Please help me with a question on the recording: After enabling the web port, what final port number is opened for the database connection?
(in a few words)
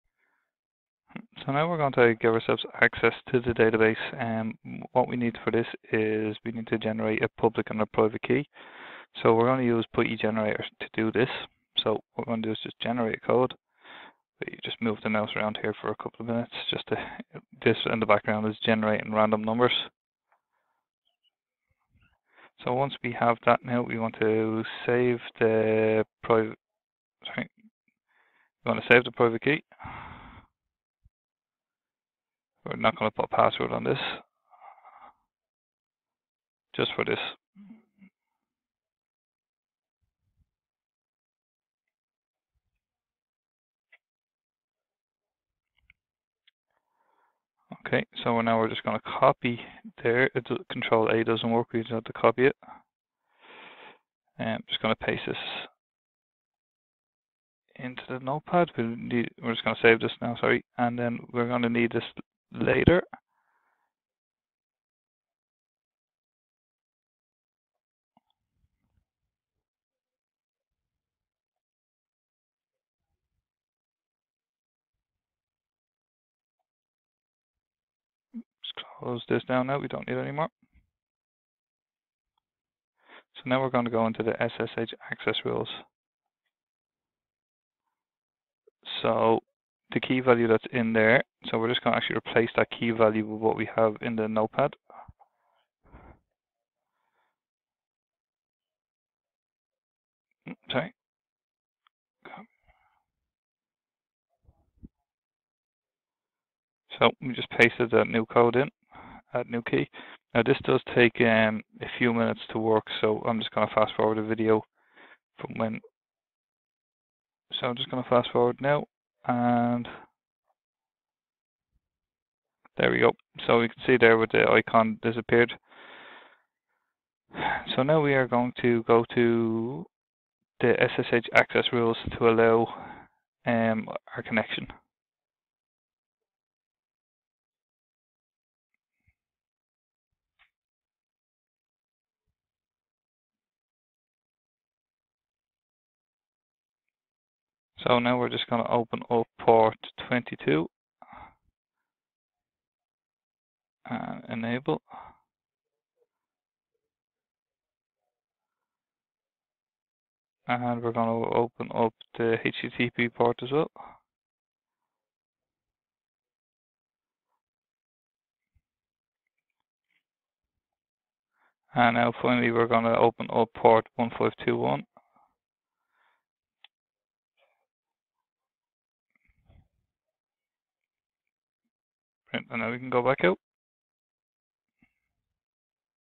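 1521.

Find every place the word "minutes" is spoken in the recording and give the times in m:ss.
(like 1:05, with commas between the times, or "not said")
0:16, 1:52.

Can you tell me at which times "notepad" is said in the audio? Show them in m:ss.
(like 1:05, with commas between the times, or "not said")
0:58, 1:34.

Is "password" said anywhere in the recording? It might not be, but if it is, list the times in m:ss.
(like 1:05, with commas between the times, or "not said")
0:33.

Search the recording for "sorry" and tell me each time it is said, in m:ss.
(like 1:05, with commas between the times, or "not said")
0:27, 1:00, 1:40.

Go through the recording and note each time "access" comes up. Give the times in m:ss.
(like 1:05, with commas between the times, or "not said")
0:02, 1:25, 2:11.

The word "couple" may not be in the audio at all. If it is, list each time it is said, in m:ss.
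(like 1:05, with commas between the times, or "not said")
0:15.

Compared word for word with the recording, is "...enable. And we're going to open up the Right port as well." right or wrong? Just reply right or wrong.
wrong.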